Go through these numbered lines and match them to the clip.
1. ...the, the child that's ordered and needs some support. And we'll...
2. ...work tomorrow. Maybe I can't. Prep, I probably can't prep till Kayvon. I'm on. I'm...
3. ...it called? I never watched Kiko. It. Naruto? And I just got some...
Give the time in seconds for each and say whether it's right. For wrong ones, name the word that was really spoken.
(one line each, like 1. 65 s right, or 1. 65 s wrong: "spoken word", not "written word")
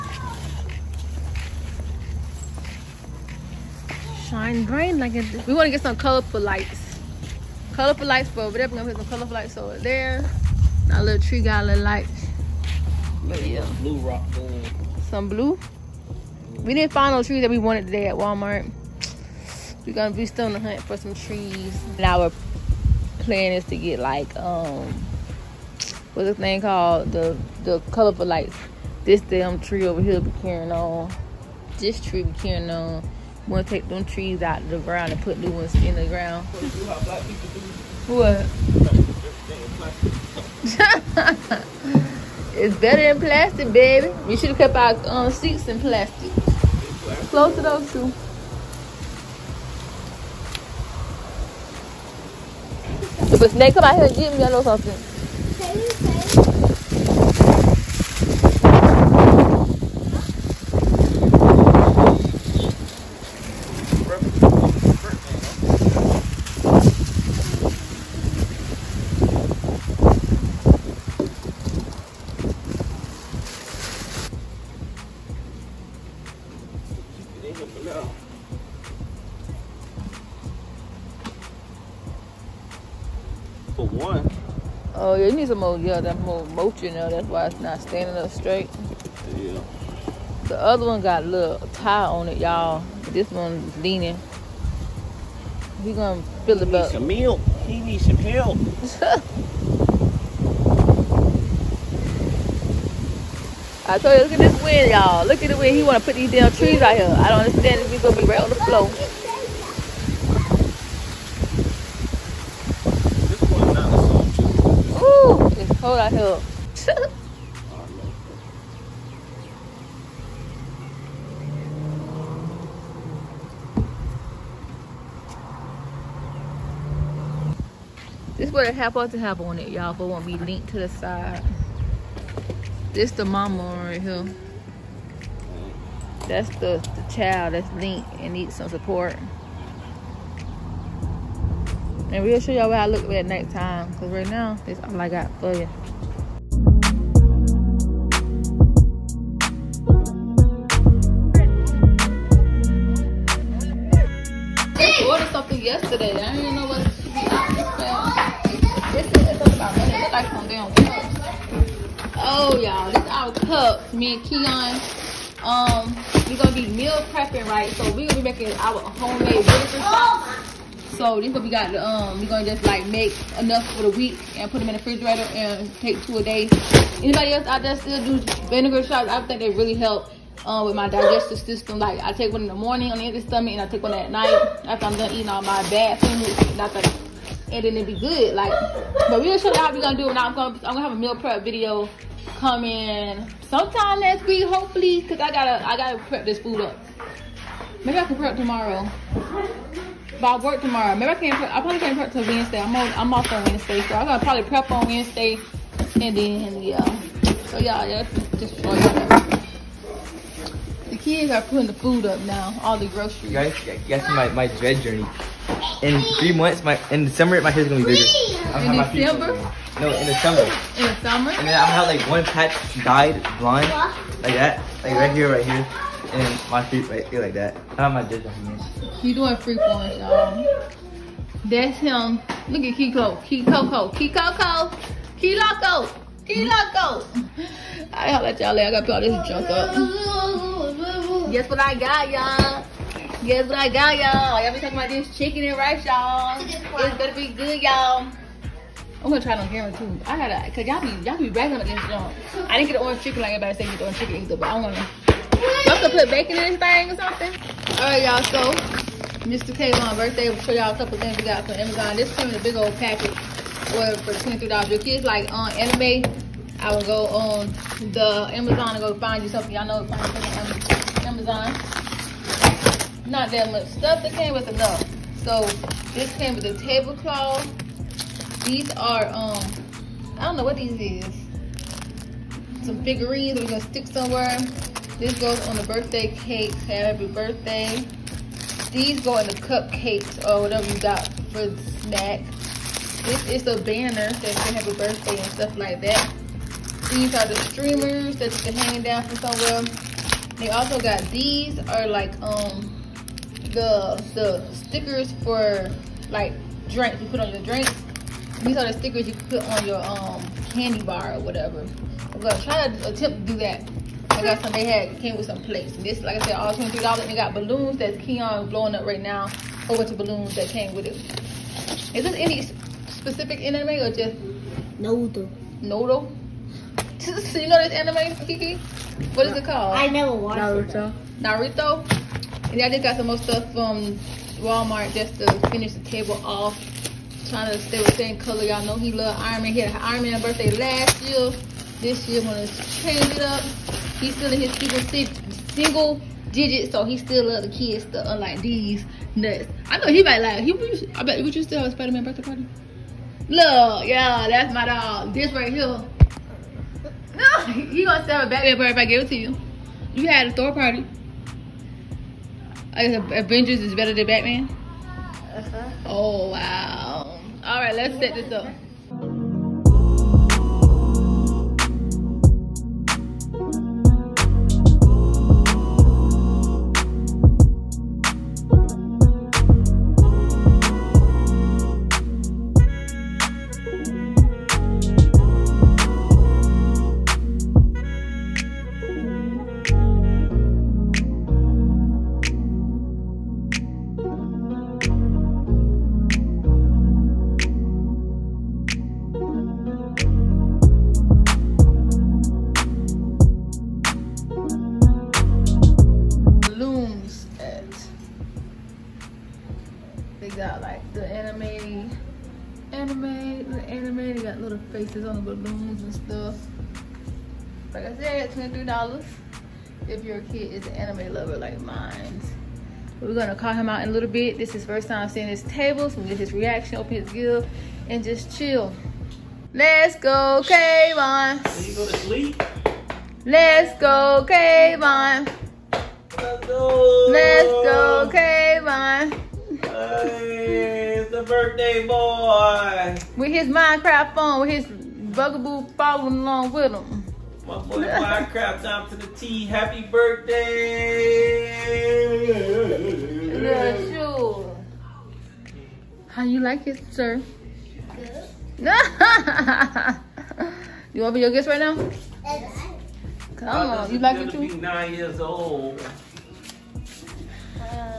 1. 136 s wrong: "linked", not "ordered"
2. 200 s wrong: "Wednesday", not "Kayvon"
3. 329 s wrong: "Naruto", not "Kiko".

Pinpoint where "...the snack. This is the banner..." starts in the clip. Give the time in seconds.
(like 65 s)
291 s.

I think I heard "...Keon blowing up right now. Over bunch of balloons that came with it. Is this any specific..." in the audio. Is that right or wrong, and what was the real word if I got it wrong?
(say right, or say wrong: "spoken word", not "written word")
right.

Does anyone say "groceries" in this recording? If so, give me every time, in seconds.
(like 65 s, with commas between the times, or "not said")
212 s.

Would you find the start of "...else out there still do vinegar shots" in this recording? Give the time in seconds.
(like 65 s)
177 s.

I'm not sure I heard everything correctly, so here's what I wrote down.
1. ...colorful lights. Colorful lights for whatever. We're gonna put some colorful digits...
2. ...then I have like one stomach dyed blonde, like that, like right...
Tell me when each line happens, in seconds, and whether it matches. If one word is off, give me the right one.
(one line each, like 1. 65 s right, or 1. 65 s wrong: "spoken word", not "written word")
1. 5 s wrong: "lights", not "digits"
2. 221 s wrong: "patch", not "stomach".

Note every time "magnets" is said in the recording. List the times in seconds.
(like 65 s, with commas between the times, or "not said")
not said.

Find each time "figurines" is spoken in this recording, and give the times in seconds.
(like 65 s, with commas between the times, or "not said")
282 s.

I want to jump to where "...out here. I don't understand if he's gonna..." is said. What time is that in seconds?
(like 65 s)
106 s.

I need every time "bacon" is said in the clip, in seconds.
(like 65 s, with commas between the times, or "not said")
256 s.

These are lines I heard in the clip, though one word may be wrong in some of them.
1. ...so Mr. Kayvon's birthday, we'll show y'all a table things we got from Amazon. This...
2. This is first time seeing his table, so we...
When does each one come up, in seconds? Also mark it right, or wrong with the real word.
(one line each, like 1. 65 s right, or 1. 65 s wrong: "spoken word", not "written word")
1. 258 s wrong: "couple", not "table"
2. 424 s right.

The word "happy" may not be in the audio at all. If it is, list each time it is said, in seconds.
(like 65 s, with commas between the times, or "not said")
286 s, 449 s.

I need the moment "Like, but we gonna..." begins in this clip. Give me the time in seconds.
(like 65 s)
188 s.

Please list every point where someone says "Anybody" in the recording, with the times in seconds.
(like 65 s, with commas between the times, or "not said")
177 s.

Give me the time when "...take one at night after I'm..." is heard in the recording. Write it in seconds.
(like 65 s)
183 s.